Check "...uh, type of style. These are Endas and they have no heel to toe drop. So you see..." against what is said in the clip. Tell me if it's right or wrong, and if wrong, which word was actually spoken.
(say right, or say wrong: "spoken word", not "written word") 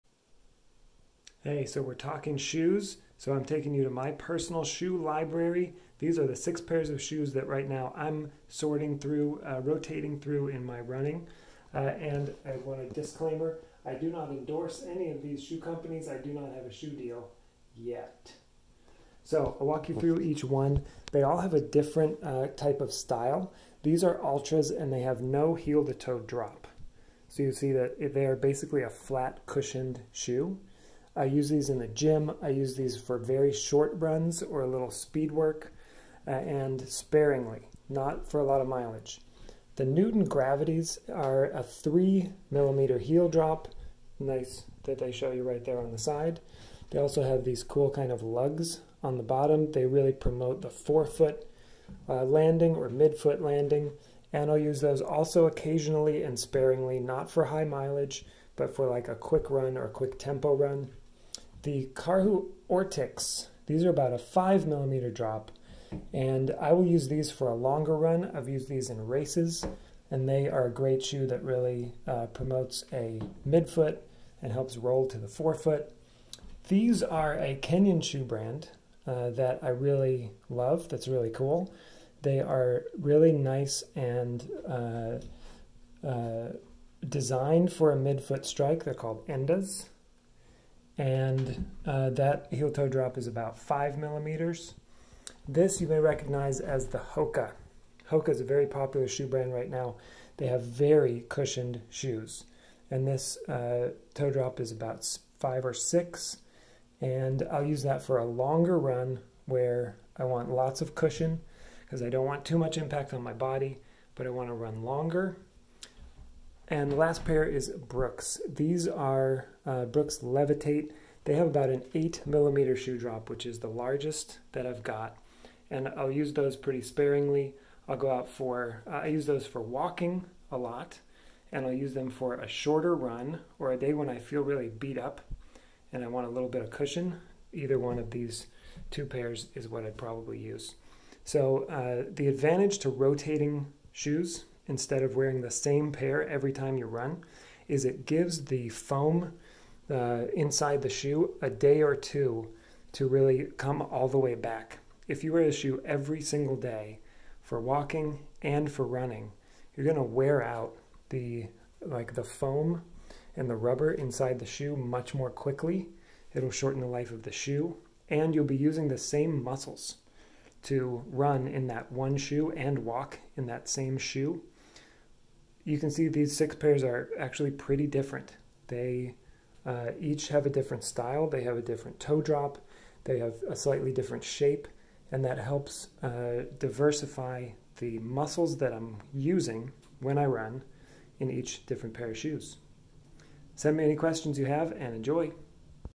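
wrong: "Altras", not "Endas".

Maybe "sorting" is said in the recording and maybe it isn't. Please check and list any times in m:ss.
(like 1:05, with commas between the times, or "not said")
0:08.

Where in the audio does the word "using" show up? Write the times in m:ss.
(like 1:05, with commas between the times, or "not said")
2:48, 3:09.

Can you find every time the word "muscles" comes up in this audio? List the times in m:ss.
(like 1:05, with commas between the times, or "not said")
2:49, 3:07.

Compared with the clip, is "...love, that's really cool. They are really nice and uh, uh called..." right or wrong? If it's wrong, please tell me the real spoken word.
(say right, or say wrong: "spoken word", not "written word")
wrong: "designed", not "called".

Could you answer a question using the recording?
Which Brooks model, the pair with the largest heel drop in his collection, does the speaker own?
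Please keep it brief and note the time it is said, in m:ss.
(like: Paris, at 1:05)
Levitate, at 2:00.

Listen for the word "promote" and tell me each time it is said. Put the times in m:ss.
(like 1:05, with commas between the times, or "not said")
0:50, 1:12.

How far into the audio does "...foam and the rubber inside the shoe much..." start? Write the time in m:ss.
2:42.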